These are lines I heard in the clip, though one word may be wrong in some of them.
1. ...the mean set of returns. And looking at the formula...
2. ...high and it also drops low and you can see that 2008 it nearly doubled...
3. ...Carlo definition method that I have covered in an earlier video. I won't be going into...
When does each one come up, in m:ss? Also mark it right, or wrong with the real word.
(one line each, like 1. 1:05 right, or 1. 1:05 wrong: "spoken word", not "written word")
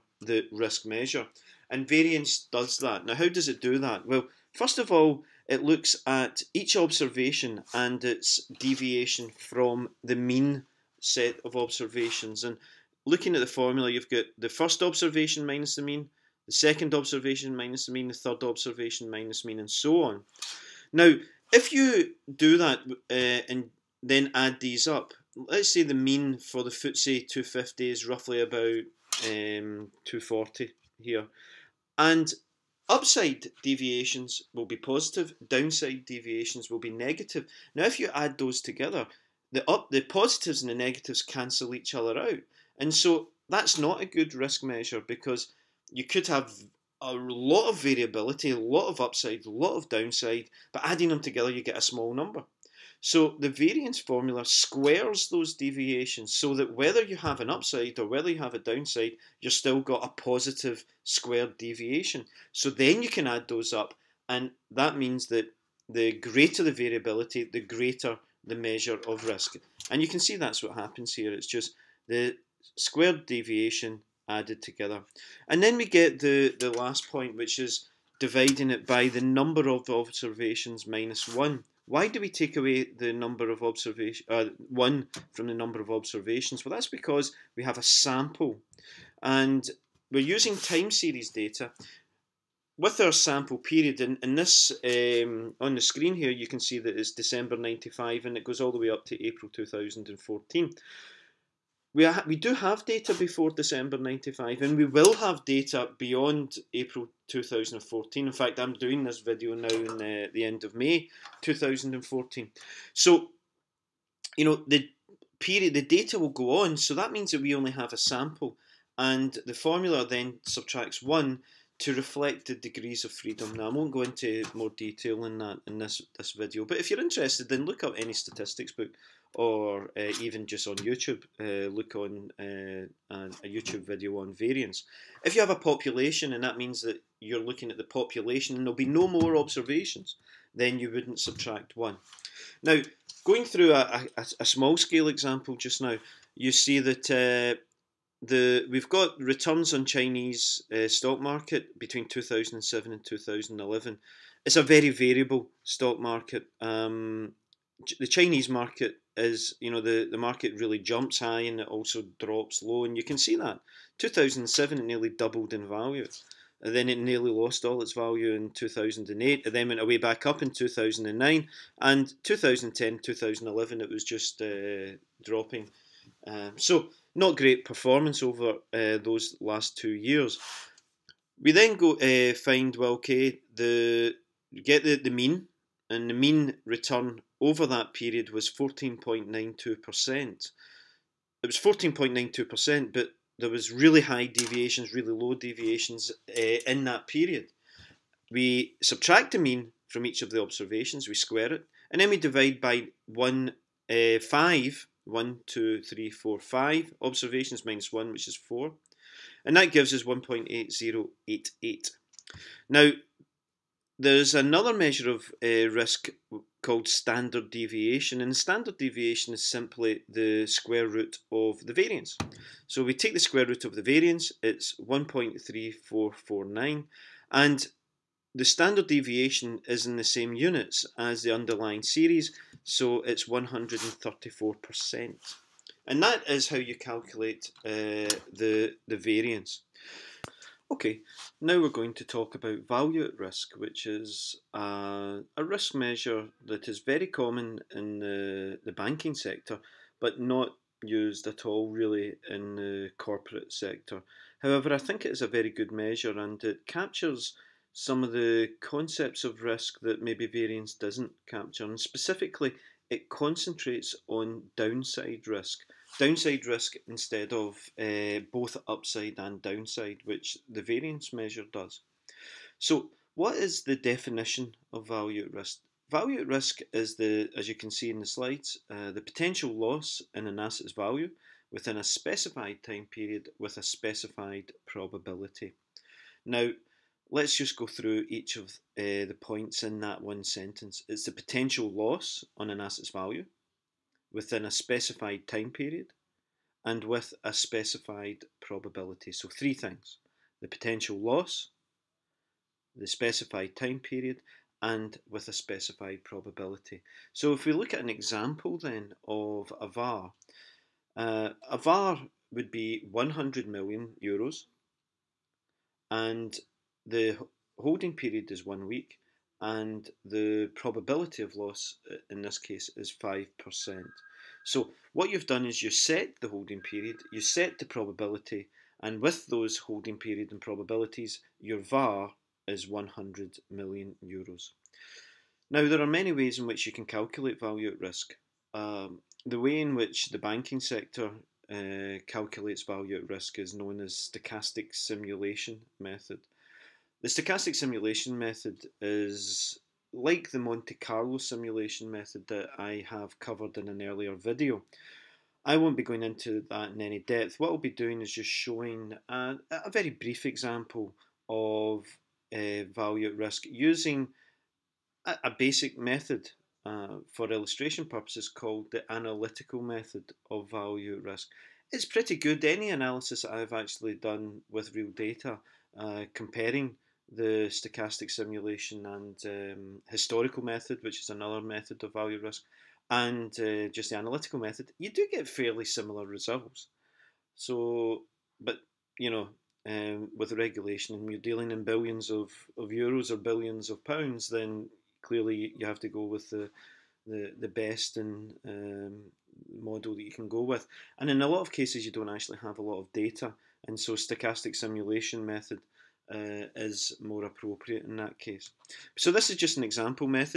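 1. 0:10 wrong: "observations", not "returns"
2. 2:41 wrong: "2007", not "2008"
3. 5:50 wrong: "simulation", not "definition".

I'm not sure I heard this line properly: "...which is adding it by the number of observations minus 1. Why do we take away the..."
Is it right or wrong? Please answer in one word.
wrong.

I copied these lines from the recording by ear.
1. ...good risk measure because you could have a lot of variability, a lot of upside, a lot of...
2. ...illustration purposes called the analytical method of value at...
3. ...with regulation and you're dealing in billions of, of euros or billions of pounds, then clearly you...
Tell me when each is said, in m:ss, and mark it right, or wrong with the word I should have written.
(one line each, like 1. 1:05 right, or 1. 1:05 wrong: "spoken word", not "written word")
1. 0:44 right
2. 6:07 right
3. 6:30 right.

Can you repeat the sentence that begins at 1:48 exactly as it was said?
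In fact, I'm doing this video now in the, uh, the end of May 2014.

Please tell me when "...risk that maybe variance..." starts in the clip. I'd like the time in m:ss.
4:19.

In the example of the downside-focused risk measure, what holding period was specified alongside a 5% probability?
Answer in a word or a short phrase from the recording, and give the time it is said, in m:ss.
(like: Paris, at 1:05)
one week, at 5:18.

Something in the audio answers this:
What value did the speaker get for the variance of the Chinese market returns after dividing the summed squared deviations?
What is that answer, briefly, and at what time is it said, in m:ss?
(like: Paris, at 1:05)
1.8088, at 3:30.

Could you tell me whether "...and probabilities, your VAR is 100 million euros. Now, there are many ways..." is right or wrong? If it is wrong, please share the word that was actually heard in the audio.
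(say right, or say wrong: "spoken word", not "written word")
right.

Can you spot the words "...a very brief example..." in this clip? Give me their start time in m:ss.
5:59.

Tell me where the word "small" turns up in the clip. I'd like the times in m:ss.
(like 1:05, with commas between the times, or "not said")
0:51, 2:24.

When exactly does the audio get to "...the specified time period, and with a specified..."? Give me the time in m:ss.
5:02.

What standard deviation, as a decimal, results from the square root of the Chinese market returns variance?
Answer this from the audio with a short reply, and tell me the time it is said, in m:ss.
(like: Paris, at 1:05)
1.3449, at 3:44.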